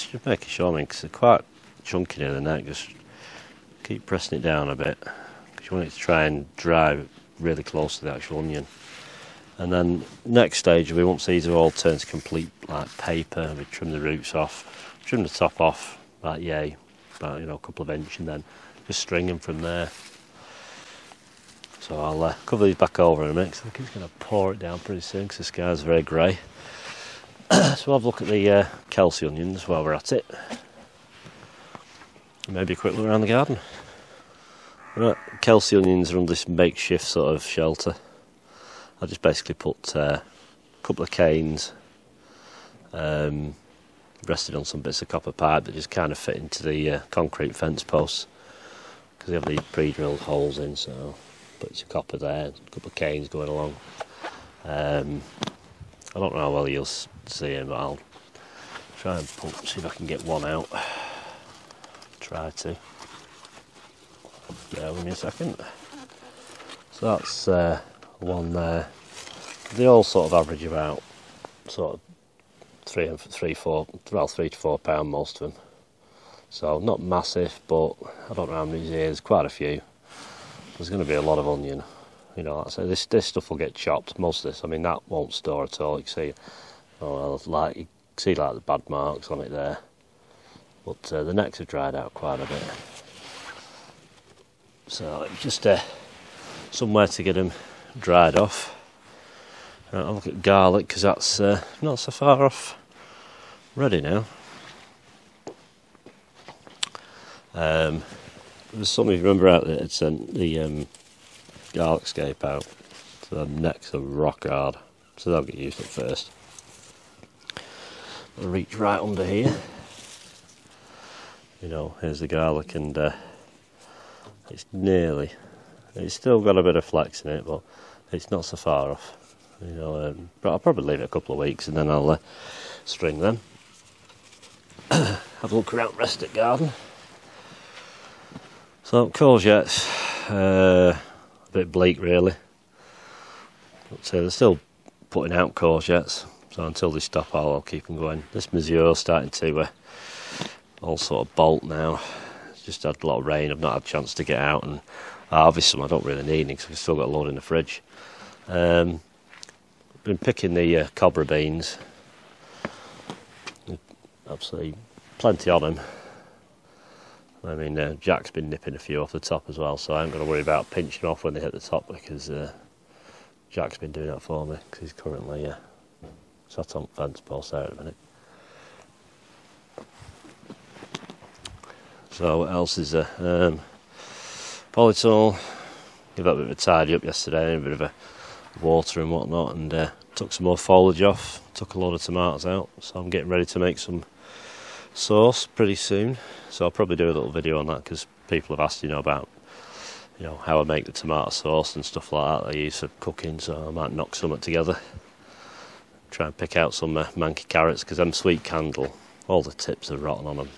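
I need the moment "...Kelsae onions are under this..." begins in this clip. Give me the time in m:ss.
0:35.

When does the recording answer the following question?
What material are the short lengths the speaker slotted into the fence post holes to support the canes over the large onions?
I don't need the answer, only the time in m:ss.
0:45.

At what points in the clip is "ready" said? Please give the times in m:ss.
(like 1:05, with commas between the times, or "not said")
1:43, 3:13.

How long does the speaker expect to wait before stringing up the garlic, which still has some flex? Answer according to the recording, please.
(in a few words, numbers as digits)
a couple of weeks.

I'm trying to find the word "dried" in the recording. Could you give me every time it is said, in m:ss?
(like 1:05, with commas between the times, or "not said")
1:31, 1:37.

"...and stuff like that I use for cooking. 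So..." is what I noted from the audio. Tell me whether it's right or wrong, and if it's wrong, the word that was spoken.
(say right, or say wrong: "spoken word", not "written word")
right.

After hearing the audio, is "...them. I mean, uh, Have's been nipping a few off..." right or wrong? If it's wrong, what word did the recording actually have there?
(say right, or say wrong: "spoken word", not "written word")
wrong: "Jack", not "Have".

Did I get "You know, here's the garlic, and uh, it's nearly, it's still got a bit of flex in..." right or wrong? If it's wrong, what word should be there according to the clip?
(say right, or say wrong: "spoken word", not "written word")
right.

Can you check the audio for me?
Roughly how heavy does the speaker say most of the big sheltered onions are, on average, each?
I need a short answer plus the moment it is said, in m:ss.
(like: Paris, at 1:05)
3 to 4 pounds, at 1:14.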